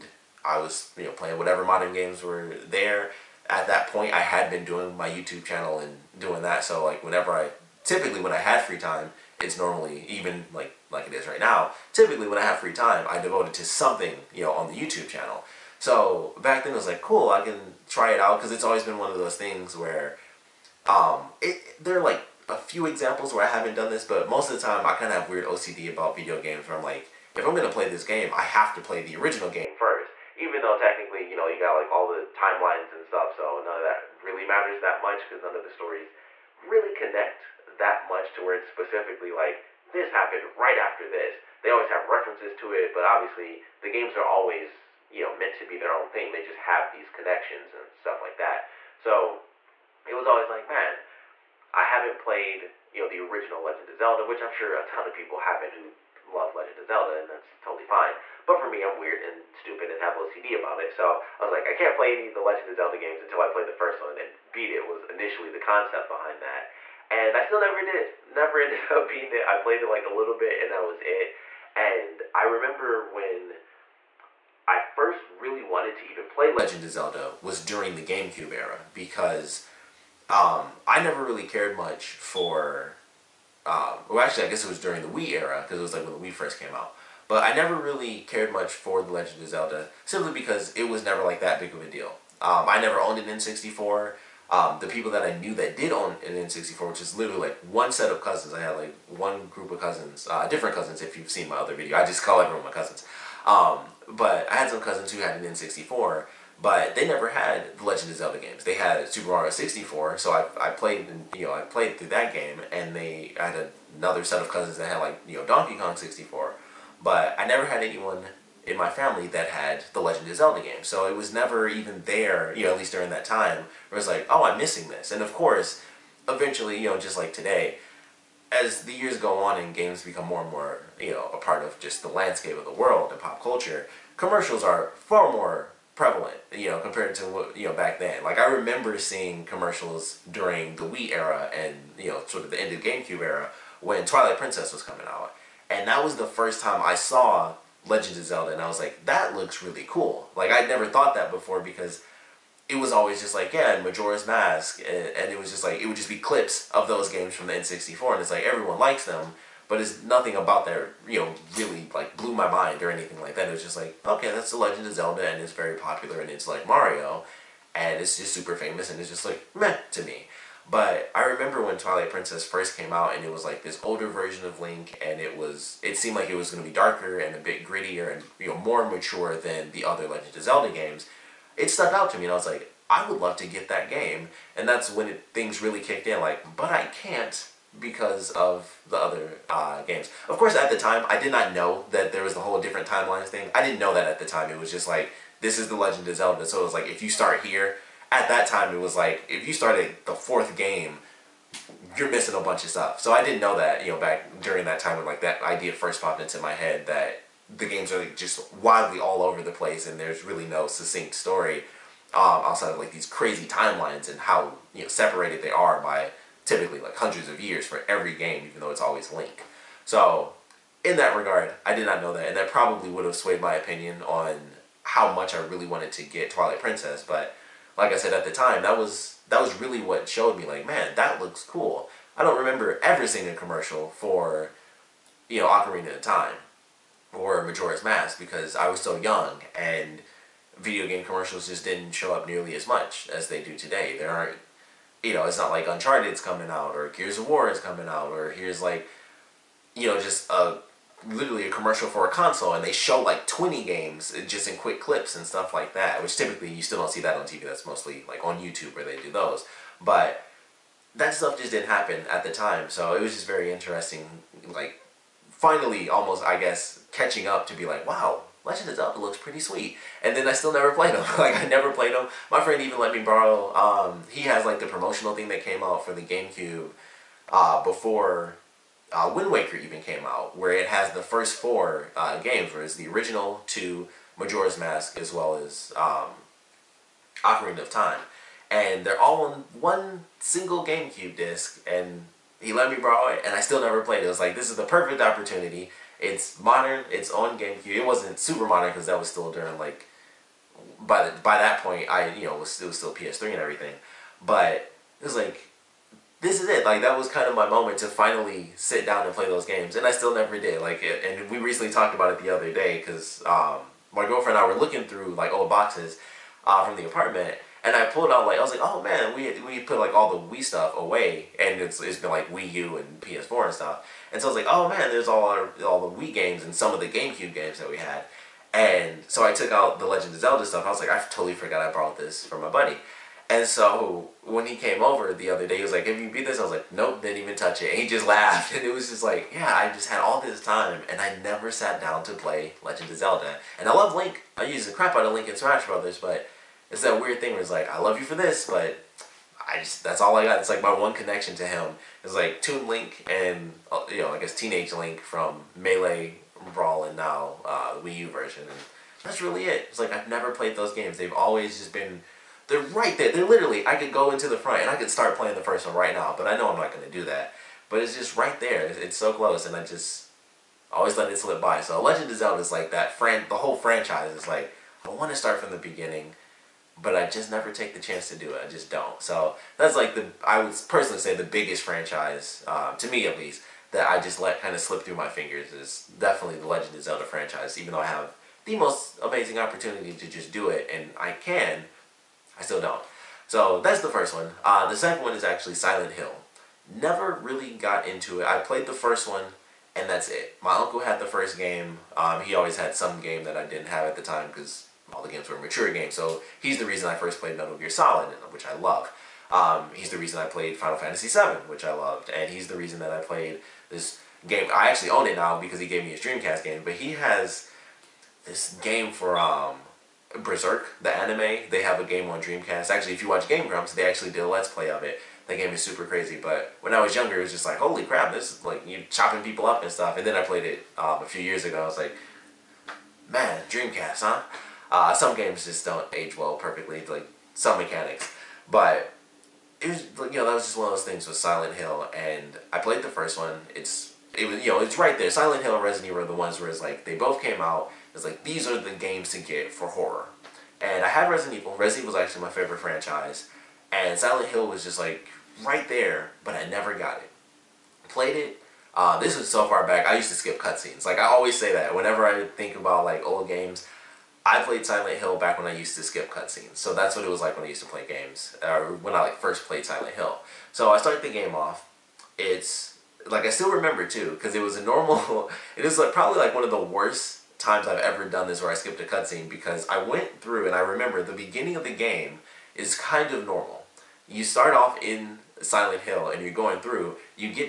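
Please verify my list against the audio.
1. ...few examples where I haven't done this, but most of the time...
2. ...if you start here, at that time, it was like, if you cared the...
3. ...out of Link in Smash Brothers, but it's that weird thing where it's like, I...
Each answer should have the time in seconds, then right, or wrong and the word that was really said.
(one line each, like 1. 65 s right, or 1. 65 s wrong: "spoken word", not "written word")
1. 22 s right
2. 196 s wrong: "started", not "cared"
3. 344 s right.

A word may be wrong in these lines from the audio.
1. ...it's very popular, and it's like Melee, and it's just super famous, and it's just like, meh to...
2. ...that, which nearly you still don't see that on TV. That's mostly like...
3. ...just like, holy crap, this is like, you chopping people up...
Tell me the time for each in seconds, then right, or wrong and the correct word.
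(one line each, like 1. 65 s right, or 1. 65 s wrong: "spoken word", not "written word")
1. 165 s wrong: "Mario", not "Melee"
2. 255 s wrong: "typically", not "nearly"
3. 427 s right.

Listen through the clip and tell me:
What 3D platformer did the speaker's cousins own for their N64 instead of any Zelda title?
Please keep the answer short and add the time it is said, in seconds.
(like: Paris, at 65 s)
Super Mario 64, at 109 s.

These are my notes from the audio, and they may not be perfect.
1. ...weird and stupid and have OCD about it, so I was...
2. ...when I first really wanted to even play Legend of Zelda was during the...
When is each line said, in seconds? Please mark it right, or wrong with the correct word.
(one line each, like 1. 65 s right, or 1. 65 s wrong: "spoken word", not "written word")
1. 58 s right
2. 73 s right.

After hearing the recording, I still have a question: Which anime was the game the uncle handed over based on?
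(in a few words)
Berserk.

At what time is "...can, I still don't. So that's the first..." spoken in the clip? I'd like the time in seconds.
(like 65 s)
391 s.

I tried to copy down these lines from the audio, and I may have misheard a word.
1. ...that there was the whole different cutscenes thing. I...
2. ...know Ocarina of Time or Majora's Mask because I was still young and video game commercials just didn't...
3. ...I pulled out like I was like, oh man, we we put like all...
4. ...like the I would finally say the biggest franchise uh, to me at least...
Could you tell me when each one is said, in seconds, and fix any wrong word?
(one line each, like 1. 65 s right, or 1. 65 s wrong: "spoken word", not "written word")
1. 191 s wrong: "timelines", not "cutscenes"
2. 235 s right
3. 317 s right
4. 379 s wrong: "personally", not "finally".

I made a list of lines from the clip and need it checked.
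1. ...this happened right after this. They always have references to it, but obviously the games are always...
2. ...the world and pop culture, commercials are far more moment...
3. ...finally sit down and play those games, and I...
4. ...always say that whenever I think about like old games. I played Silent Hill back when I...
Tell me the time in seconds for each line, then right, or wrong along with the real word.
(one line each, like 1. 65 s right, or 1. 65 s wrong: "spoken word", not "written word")
1. 39 s right
2. 132 s wrong: "prevalent", not "moment"
3. 307 s right
4. 461 s right.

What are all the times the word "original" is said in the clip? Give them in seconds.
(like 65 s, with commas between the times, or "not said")
29 s, 53 s, 282 s.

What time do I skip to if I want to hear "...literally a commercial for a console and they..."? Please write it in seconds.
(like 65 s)
251 s.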